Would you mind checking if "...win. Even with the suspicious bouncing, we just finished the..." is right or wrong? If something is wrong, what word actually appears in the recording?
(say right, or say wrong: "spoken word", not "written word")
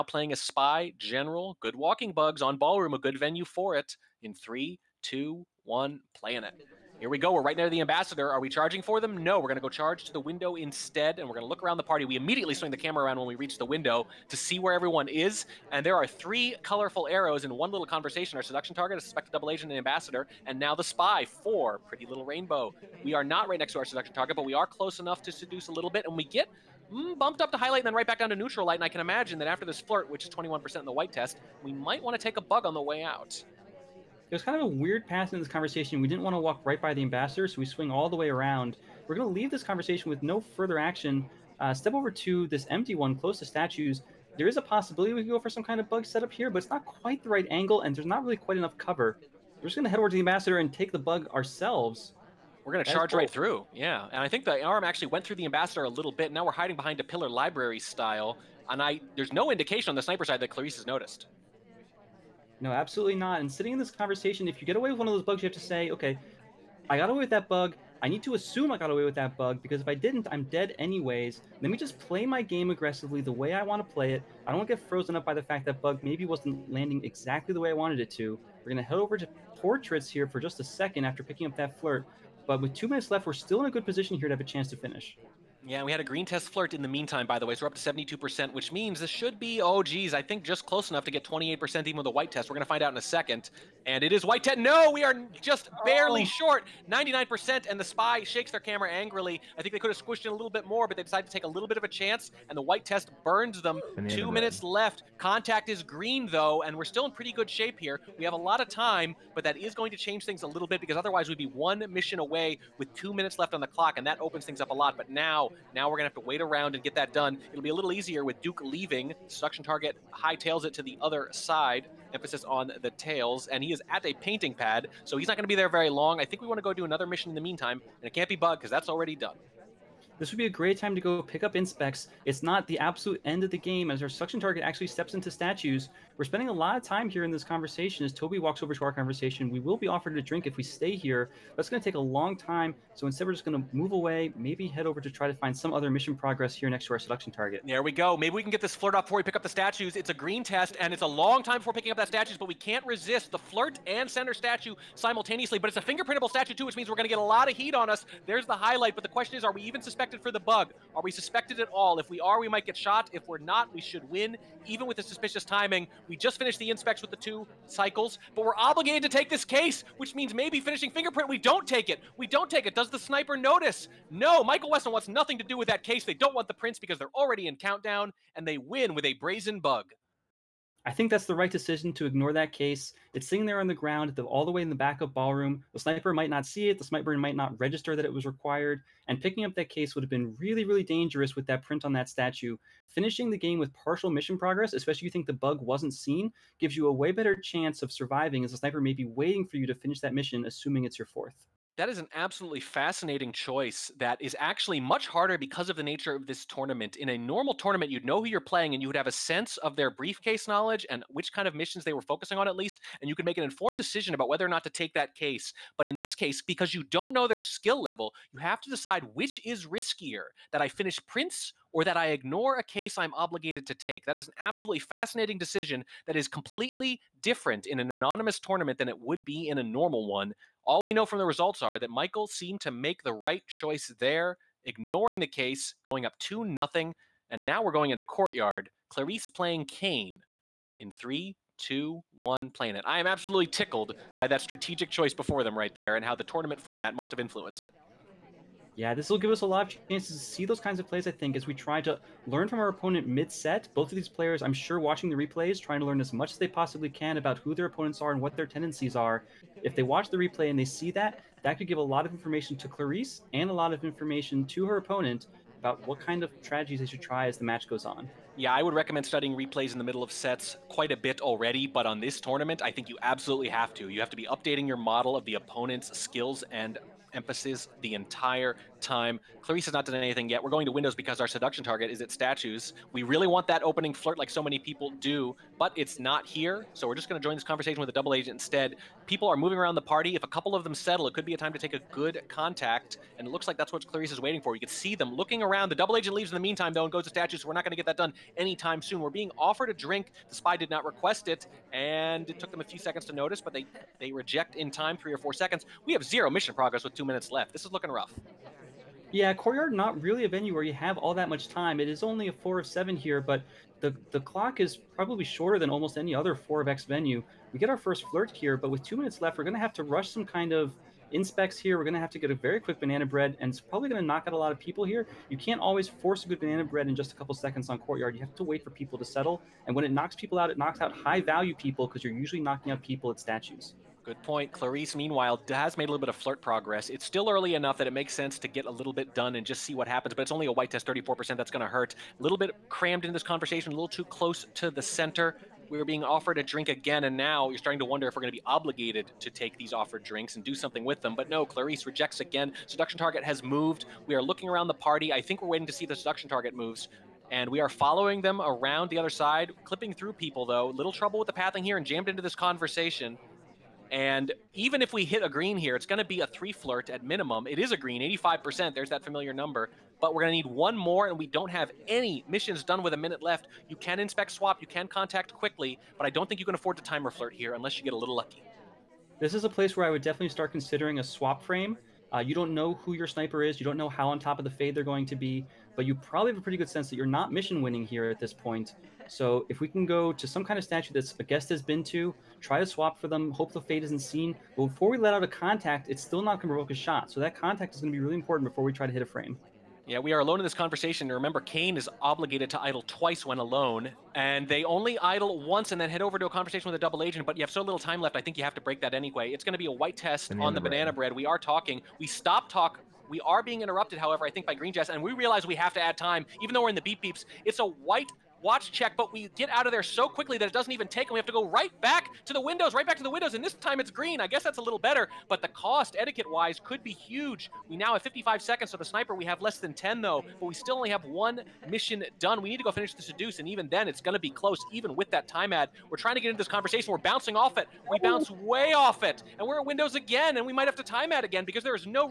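wrong: "timing", not "bouncing".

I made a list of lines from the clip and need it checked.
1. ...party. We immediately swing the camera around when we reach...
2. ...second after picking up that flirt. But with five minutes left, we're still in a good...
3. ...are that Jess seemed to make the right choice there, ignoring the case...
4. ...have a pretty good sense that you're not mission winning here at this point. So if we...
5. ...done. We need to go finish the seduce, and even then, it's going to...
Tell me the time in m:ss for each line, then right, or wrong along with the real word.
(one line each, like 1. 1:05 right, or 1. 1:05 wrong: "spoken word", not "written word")
1. 0:11 right
2. 1:20 wrong: "two", not "five"
3. 3:51 wrong: "Michael", not "Jess"
4. 6:26 right
5. 7:12 right.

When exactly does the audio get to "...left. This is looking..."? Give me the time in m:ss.
5:07.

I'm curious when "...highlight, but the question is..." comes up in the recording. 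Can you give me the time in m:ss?
2:38.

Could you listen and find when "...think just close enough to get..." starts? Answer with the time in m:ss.
1:30.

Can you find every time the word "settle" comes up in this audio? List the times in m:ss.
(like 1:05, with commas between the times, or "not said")
4:50, 5:29.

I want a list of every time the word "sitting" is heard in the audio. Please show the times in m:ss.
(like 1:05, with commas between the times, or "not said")
1:03, 3:03.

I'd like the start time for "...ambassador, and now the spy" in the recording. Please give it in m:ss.
0:19.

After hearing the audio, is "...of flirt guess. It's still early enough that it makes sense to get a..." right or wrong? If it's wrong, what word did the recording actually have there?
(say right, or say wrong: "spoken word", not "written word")
wrong: "progress", not "guess".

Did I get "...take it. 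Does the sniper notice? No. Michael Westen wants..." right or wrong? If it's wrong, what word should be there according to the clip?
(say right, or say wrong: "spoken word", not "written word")
right.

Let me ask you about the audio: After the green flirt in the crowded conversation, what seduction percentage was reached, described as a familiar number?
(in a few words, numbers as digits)
85%.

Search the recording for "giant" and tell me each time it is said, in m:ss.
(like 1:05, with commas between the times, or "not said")
not said.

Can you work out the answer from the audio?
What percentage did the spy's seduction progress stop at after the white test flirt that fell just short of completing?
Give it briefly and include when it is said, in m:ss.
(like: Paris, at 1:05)
99%, at 1:36.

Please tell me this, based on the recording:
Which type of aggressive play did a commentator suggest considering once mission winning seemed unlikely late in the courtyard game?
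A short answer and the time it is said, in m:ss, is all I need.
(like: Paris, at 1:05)
swap frame, at 6:21.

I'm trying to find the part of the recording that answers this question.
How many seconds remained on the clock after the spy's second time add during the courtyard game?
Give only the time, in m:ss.
7:08.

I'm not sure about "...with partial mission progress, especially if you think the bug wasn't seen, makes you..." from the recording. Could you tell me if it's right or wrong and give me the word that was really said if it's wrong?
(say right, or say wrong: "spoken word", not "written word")
wrong: "gives", not "makes".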